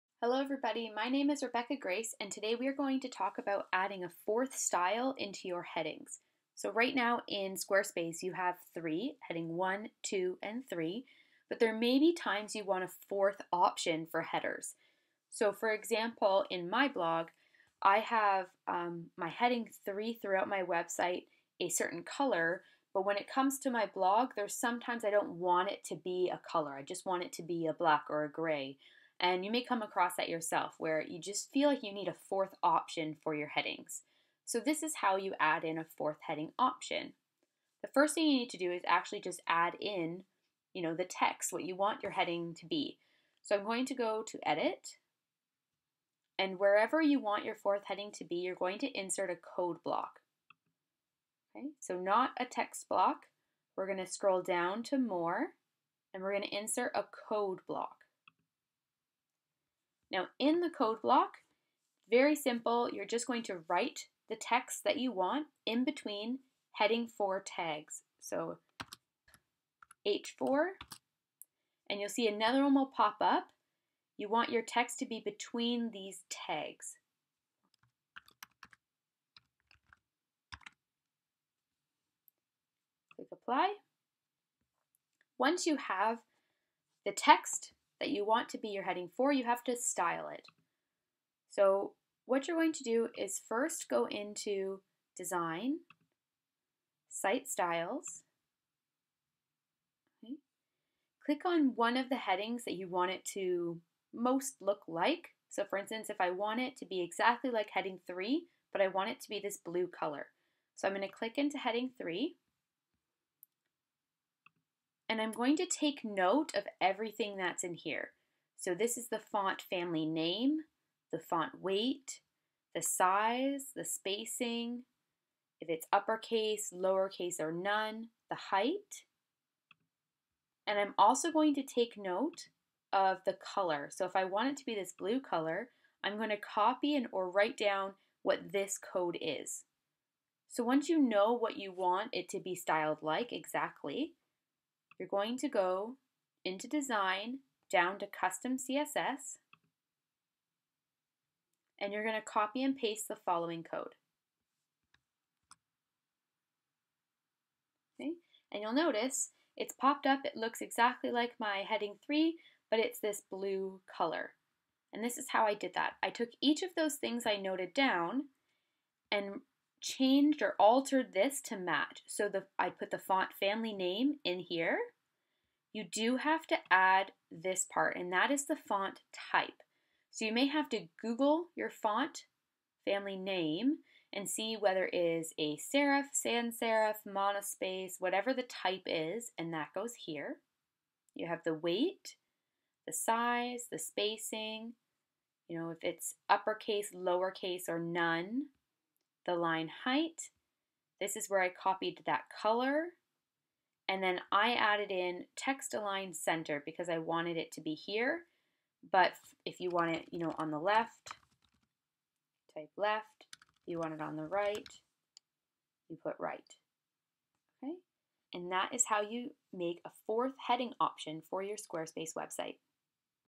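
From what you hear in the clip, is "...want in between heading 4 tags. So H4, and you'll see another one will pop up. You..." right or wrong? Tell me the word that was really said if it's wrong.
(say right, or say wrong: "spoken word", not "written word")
right.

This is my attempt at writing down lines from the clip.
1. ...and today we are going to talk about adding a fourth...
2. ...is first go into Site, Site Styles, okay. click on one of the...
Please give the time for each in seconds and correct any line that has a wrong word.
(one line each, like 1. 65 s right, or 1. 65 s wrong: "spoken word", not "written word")
1. 2 s right
2. 93 s wrong: "Design", not "Site".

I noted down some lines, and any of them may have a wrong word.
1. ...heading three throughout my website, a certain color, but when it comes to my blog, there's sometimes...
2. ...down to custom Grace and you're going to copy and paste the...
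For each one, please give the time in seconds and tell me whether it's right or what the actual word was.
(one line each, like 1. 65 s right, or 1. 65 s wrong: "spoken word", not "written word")
1. 19 s right
2. 147 s wrong: "CSS", not "Grace".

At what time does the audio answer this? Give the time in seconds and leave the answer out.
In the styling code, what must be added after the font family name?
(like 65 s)
178 s.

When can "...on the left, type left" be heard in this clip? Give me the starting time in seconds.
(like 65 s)
210 s.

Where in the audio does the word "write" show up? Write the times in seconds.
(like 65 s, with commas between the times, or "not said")
63 s, 137 s.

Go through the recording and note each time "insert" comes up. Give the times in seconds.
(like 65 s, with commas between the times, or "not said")
48 s, 56 s.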